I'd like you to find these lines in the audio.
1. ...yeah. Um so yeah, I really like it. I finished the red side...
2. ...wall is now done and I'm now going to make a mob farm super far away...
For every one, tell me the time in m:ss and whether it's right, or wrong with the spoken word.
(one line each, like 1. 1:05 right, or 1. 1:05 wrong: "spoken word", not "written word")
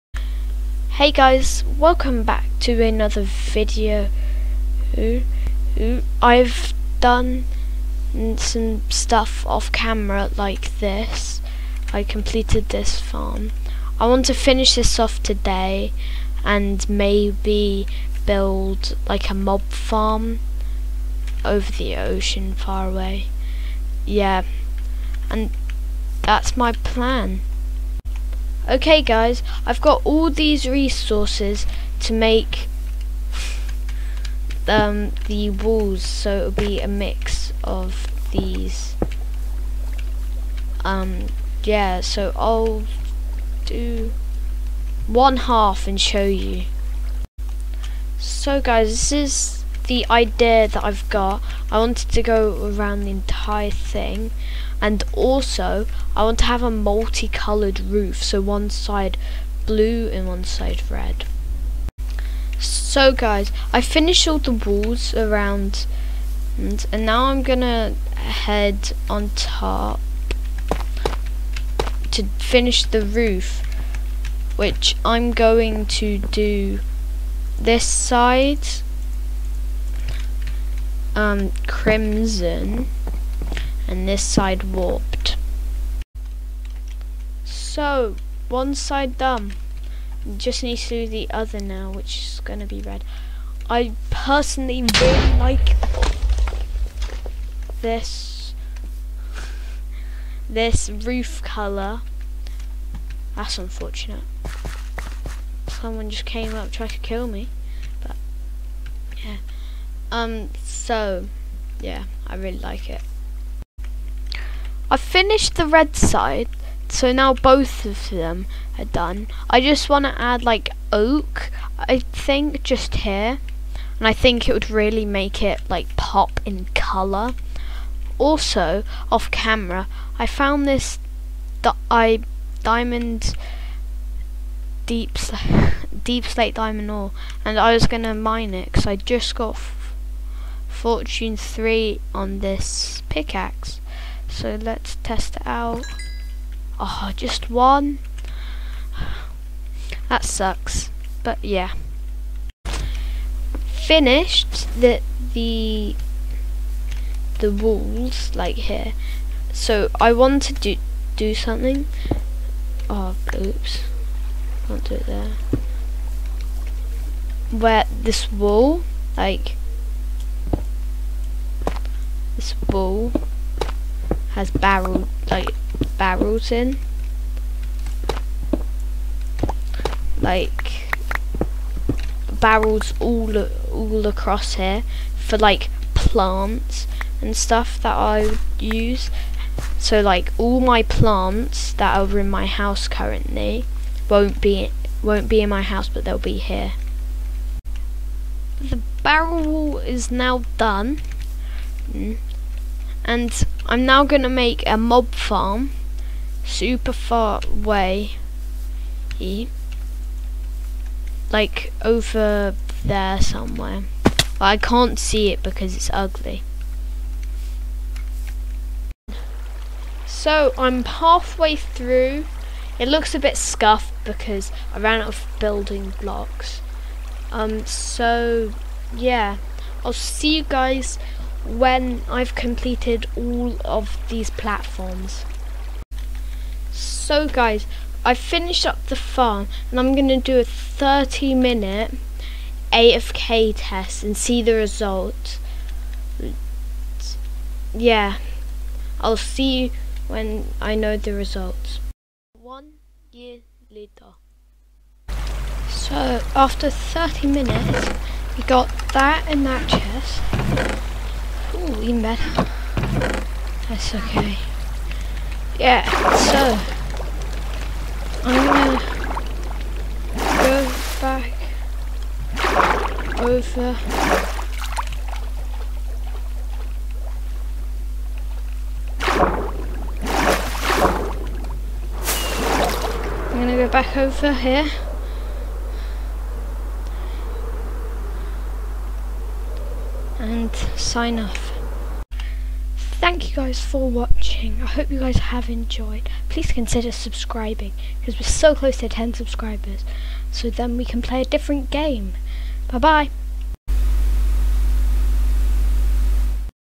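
1. 1:49 right
2. 3:19 right.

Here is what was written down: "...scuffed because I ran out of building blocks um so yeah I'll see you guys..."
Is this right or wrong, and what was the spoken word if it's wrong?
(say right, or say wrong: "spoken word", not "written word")
right.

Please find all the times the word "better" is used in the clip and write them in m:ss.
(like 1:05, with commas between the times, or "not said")
4:22.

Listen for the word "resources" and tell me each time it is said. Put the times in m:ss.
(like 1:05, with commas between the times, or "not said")
0:30.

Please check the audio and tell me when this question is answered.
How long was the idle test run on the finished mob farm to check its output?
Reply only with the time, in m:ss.
4:00.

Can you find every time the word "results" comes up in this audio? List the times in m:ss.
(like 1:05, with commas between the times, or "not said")
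4:04, 4:11.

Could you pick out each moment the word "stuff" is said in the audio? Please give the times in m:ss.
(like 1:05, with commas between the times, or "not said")
0:08, 3:07.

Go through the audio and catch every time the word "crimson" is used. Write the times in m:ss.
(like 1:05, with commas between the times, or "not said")
1:21.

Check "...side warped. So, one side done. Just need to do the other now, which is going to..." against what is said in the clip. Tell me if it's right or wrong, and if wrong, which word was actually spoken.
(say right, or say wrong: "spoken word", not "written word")
right.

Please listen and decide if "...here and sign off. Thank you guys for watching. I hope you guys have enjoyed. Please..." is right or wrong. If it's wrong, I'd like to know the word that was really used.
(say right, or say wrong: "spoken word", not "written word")
right.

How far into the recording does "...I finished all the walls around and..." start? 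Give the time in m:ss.
1:03.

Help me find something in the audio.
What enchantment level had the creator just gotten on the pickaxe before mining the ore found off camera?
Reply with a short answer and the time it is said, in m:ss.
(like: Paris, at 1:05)
fortune 3, at 2:20.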